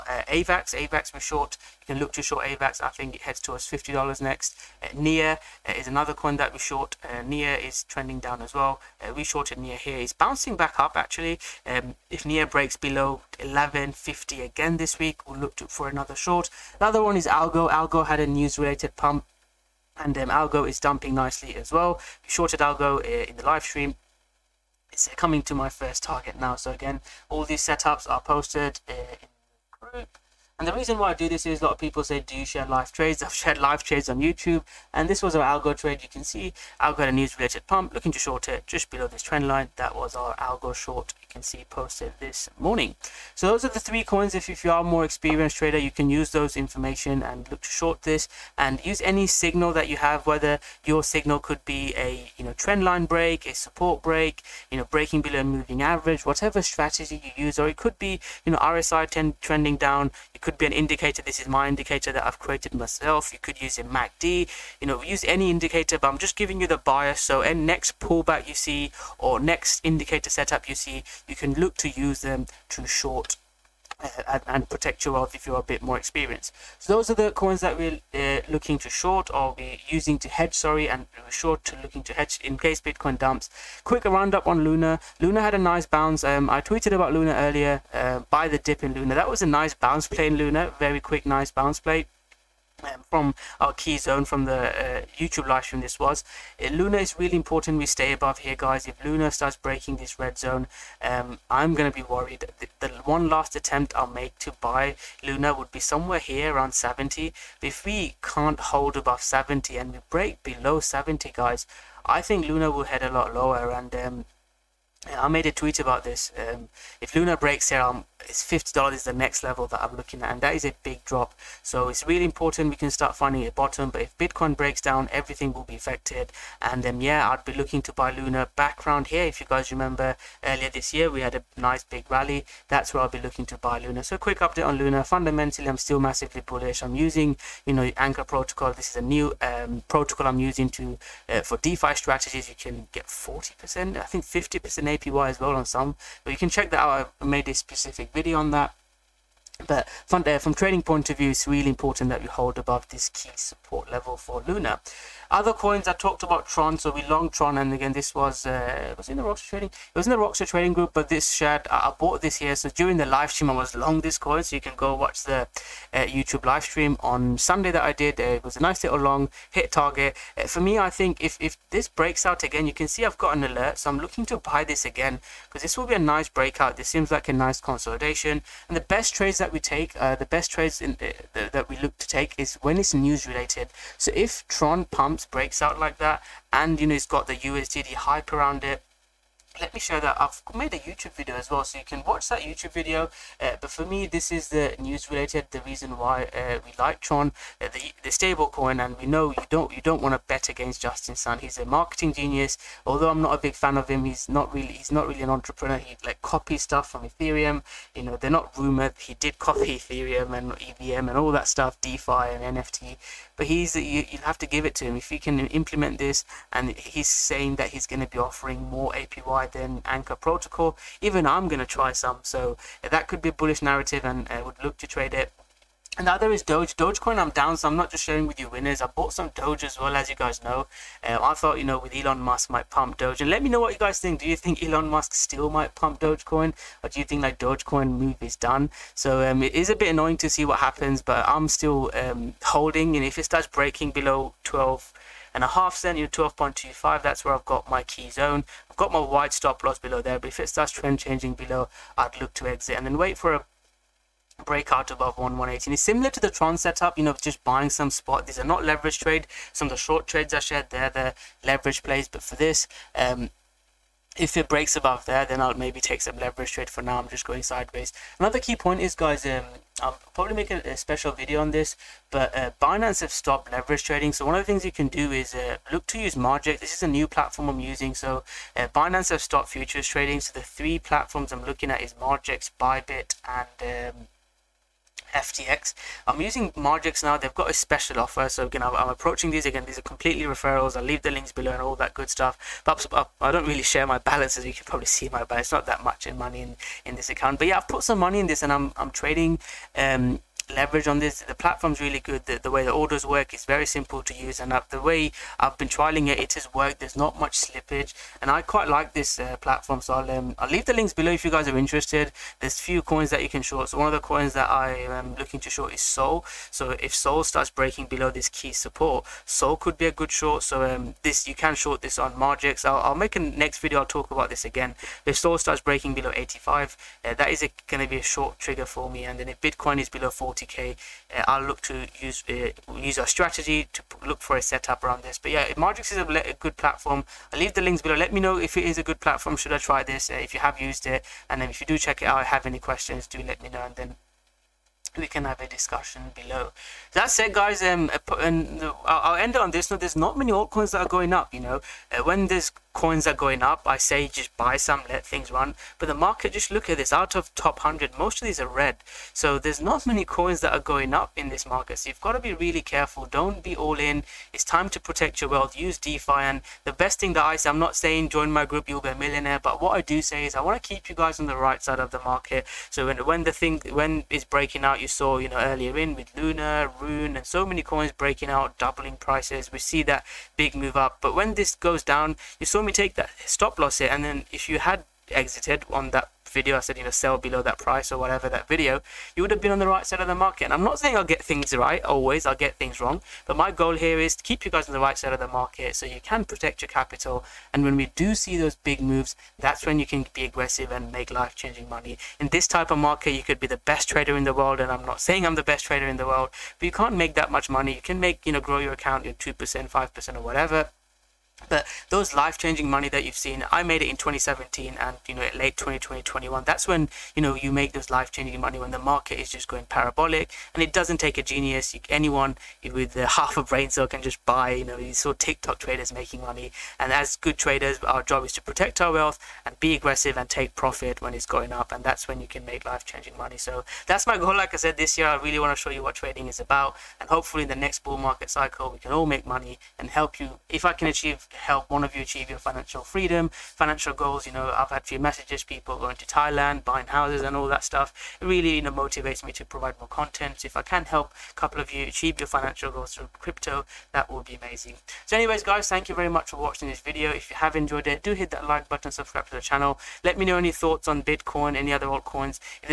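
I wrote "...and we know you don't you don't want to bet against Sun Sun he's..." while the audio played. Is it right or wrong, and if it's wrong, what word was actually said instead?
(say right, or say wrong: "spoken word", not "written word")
wrong: "Justin", not "Sun".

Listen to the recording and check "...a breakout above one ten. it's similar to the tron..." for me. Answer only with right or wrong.
wrong.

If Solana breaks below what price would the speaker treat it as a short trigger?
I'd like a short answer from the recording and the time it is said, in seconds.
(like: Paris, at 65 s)
85, at 326 s.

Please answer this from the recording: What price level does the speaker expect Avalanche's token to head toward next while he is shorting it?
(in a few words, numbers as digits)
$50.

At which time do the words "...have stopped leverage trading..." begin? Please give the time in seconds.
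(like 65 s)
273 s.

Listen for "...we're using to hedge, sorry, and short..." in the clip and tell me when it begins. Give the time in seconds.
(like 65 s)
79 s.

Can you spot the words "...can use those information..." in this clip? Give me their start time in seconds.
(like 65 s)
45 s.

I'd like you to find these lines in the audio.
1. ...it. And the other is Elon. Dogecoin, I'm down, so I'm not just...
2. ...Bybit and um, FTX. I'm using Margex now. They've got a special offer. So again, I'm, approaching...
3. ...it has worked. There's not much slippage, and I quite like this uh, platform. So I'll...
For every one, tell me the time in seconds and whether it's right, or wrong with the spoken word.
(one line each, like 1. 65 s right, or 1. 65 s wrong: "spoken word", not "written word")
1. 225 s wrong: "Doge", not "Elon"
2. 282 s right
3. 306 s right.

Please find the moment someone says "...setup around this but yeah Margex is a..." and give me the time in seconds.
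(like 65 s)
334 s.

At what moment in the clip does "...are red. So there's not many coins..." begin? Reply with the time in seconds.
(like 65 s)
358 s.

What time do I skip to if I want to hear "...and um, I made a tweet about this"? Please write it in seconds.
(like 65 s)
113 s.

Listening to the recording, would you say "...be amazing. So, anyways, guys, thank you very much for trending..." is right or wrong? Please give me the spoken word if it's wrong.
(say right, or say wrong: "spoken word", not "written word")
wrong: "watching", not "trending".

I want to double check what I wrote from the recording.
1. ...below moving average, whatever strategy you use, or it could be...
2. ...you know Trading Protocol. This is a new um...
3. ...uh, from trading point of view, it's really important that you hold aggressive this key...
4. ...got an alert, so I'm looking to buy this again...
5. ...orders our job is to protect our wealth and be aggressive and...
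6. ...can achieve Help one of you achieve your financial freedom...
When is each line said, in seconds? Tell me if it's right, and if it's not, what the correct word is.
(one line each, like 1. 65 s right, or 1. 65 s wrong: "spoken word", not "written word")
1. 55 s right
2. 137 s wrong: "Anchor", not "Trading"
3. 150 s wrong: "above", not "aggressive"
4. 173 s right
5. 427 s wrong: "traders", not "orders"
6. 440 s right.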